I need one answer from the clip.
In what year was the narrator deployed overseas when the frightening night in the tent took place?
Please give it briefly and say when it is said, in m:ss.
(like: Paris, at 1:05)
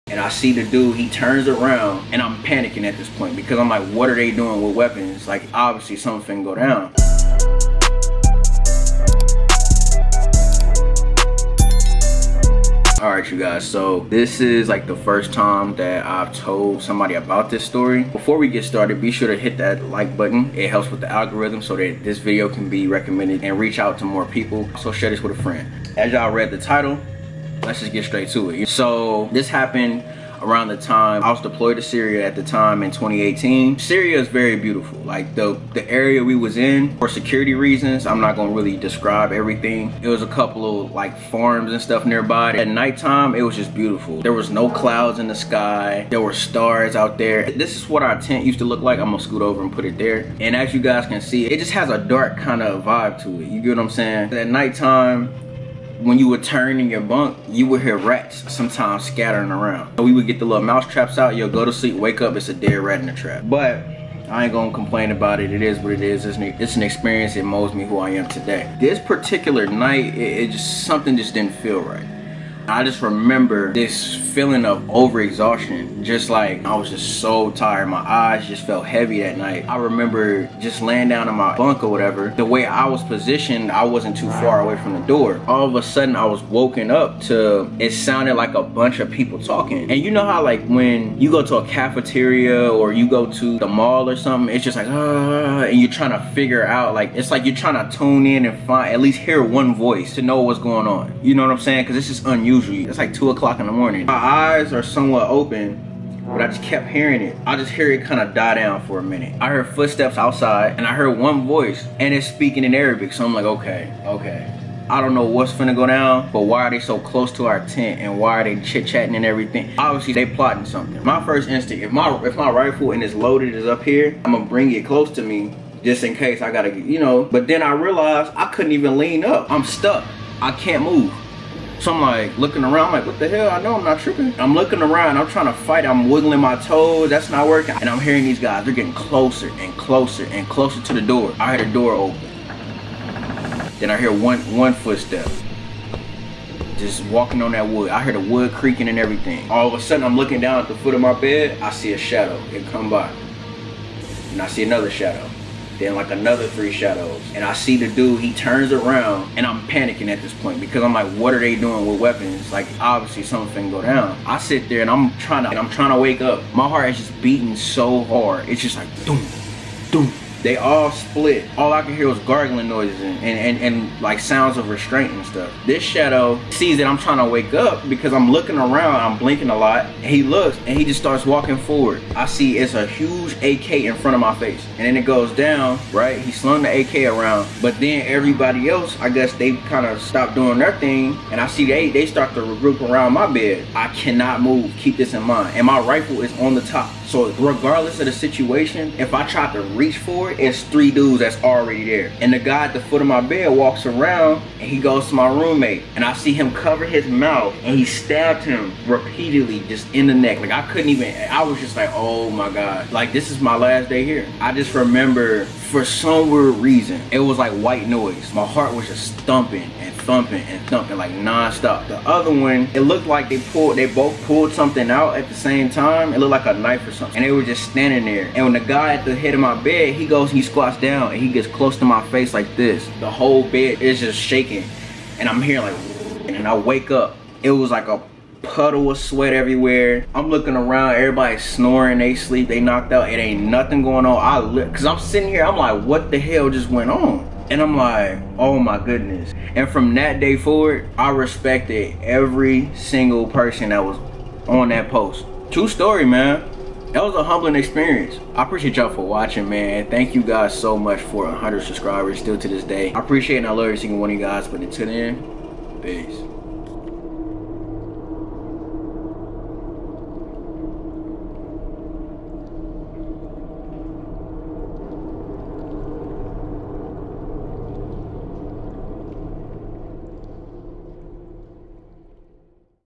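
2018, at 0:32.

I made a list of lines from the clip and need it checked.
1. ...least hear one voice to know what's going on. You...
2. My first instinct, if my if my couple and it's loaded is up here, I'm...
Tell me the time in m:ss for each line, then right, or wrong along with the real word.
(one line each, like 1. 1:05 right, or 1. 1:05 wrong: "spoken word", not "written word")
1. 1:39 right
2. 2:01 wrong: "rifle", not "couple".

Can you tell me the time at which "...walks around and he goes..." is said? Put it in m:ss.
3:23.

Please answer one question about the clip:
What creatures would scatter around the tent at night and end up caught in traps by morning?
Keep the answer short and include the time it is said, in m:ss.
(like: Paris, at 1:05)
Rats, at 0:57.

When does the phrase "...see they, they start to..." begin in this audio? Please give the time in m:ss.
3:11.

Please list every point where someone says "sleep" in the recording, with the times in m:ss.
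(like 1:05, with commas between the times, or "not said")
1:01, 4:02.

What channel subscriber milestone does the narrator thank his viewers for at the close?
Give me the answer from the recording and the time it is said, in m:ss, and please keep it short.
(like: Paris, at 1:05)
100 subscribers, at 4:21.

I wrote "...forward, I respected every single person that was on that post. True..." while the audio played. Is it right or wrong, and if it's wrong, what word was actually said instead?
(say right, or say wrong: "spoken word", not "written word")
right.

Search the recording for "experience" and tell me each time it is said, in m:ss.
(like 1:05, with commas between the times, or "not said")
1:06, 4:17.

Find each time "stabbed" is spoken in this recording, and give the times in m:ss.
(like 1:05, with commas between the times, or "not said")
3:27.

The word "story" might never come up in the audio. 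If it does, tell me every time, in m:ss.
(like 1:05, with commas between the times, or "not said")
0:17, 4:15.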